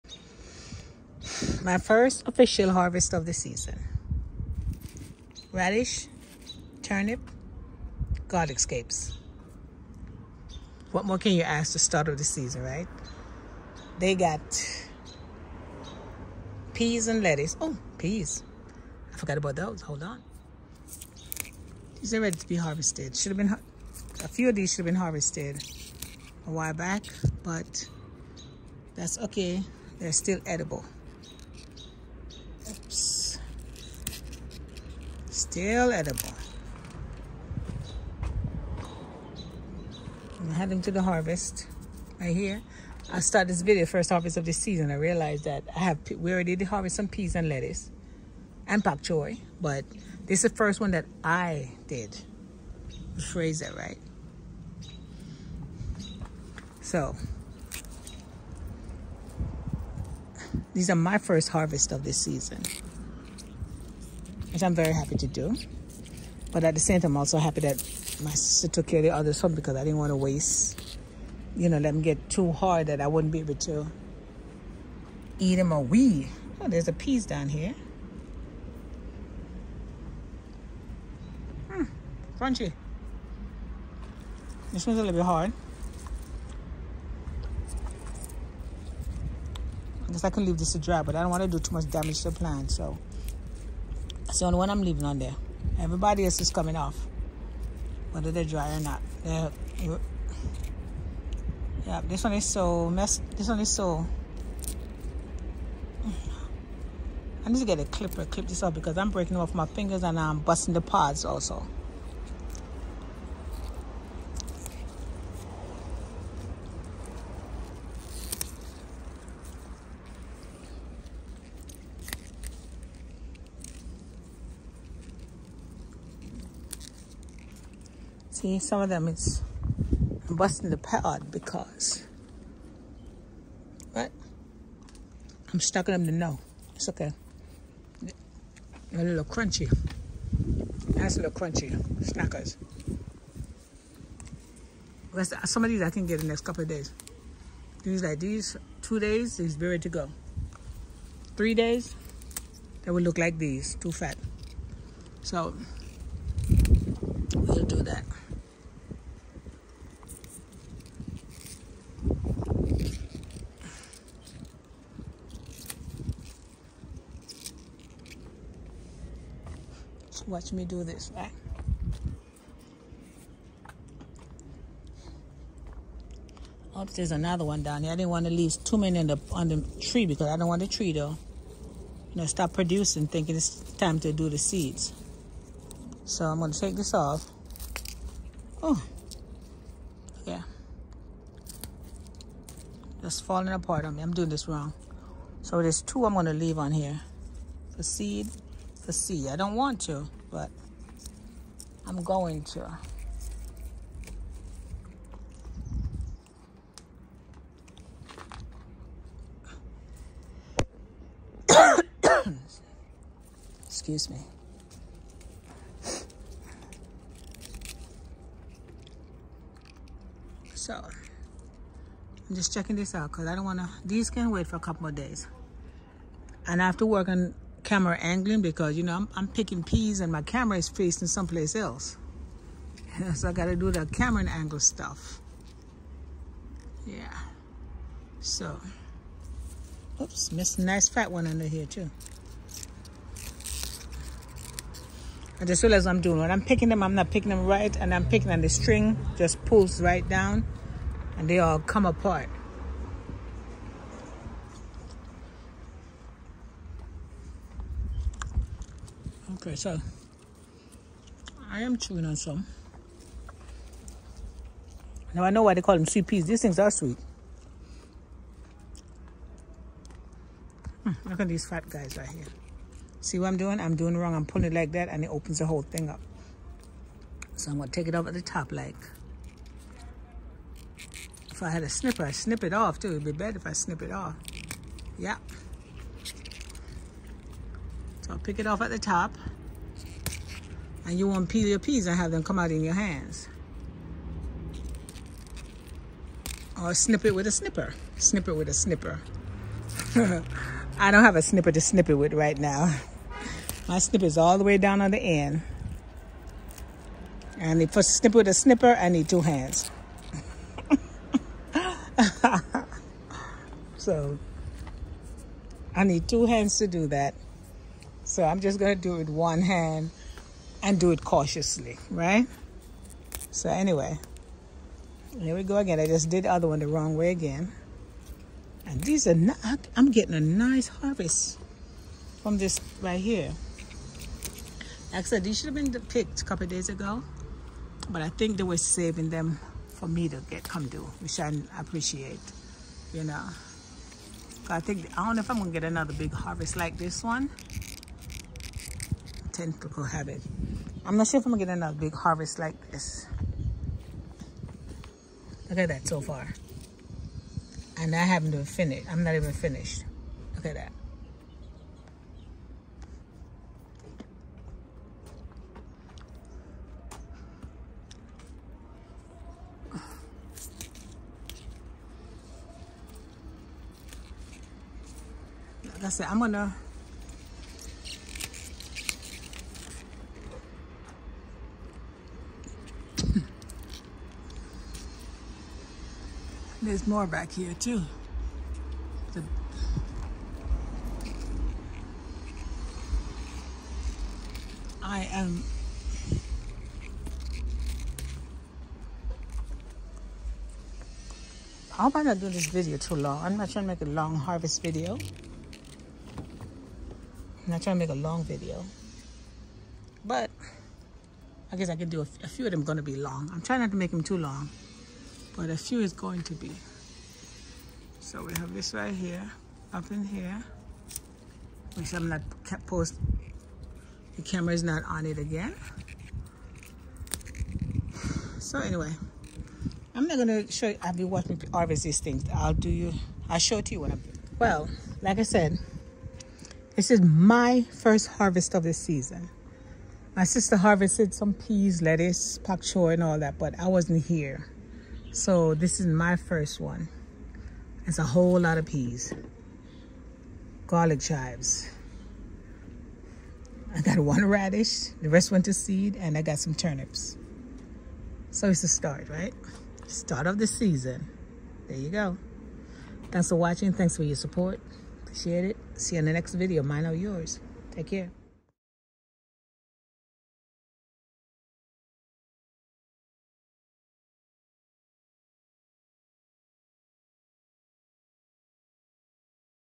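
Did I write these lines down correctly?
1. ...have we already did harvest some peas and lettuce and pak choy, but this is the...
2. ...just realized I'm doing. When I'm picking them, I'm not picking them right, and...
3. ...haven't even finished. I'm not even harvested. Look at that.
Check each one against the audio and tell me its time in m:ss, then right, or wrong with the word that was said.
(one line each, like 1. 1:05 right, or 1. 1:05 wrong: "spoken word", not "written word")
1. 0:45 right
2. 4:05 right
3. 5:58 wrong: "finished", not "harvested".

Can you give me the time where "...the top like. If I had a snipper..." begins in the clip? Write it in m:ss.
4:38.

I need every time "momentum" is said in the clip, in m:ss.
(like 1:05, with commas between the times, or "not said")
not said.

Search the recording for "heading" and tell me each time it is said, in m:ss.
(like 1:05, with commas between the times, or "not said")
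0:40.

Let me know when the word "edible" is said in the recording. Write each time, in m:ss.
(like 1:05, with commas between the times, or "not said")
0:30, 0:35.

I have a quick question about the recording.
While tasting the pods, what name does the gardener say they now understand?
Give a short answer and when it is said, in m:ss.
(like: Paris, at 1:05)
Sweet peas, at 4:25.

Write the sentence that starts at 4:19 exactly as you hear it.
Okay, so I am chewing on some.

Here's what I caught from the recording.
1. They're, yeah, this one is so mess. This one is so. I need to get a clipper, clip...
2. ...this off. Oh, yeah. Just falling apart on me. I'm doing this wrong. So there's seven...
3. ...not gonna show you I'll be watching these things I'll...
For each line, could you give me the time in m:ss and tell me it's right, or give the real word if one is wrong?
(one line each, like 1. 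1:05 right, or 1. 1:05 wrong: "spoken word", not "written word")
1. 1:39 right
2. 3:06 wrong: "two", not "seven"
3. 7:10 right.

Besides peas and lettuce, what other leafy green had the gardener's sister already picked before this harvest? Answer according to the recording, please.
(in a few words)
Pak choi.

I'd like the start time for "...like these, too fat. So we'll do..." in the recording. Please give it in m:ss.
2:33.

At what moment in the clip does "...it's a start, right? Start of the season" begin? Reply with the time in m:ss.
7:38.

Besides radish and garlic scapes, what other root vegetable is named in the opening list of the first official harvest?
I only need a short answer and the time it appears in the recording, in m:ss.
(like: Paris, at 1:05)
Turnip, at 0:06.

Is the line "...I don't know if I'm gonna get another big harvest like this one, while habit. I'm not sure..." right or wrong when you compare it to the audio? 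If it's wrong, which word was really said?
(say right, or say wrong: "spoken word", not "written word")
wrong: "tentacle", not "while".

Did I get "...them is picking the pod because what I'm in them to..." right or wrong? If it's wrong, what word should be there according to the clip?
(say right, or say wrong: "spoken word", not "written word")
wrong: "busting", not "picking".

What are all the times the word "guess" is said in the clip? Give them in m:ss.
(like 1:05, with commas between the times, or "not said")
1:30, 6:51.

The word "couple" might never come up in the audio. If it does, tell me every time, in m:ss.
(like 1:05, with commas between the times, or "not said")
2:26, 3:44, 5:36.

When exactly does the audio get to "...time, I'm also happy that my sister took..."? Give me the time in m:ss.
1:07.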